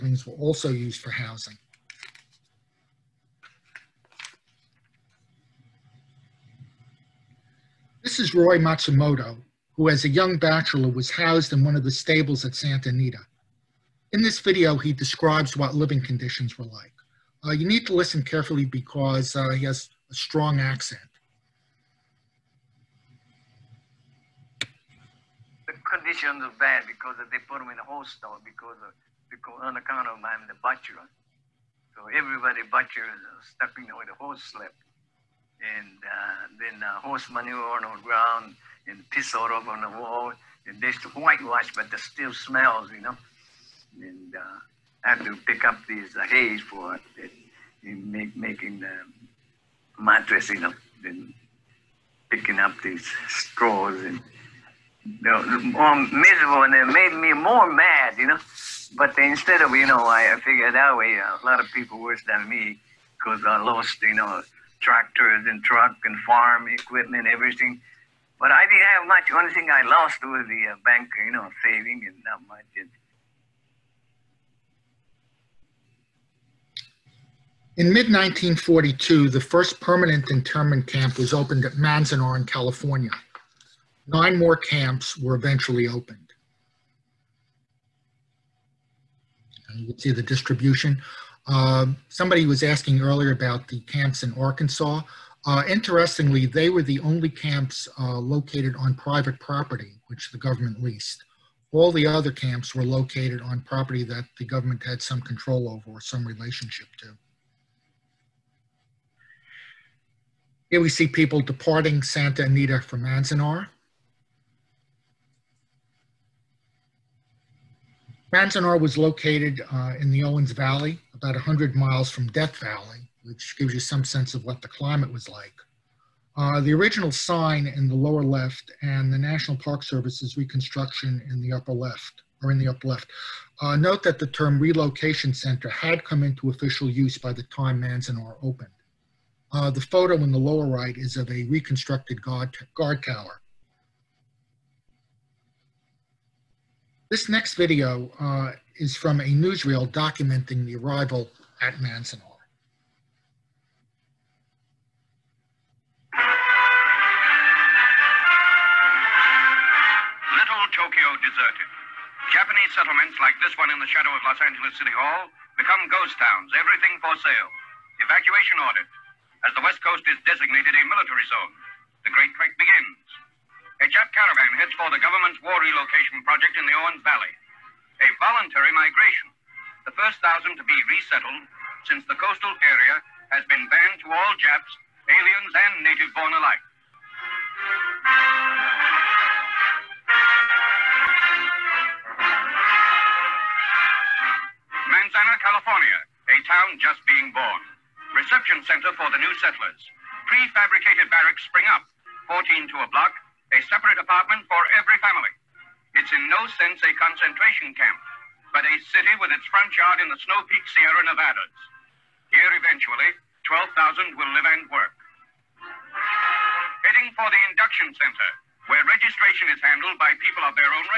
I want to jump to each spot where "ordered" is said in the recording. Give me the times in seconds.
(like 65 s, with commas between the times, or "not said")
168 s.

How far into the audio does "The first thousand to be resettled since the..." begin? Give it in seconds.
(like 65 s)
179 s.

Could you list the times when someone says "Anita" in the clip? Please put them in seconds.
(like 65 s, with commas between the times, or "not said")
12 s, 112 s.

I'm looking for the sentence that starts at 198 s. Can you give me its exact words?
Reception center for the new settlers.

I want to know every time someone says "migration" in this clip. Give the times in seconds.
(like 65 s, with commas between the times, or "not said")
178 s.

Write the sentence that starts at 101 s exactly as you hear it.
All the other camps were located on property that the government had some control over or some relationship to.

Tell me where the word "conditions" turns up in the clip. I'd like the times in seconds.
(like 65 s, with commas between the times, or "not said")
16 s, 25 s.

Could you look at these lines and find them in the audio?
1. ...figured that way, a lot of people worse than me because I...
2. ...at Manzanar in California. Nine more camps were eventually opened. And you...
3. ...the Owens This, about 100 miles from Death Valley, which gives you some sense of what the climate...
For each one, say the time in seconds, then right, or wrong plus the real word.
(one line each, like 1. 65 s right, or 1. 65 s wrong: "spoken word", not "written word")
1. 60 s right
2. 81 s right
3. 120 s wrong: "Valley", not "This".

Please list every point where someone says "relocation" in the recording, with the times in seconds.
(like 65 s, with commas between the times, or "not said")
134 s, 175 s.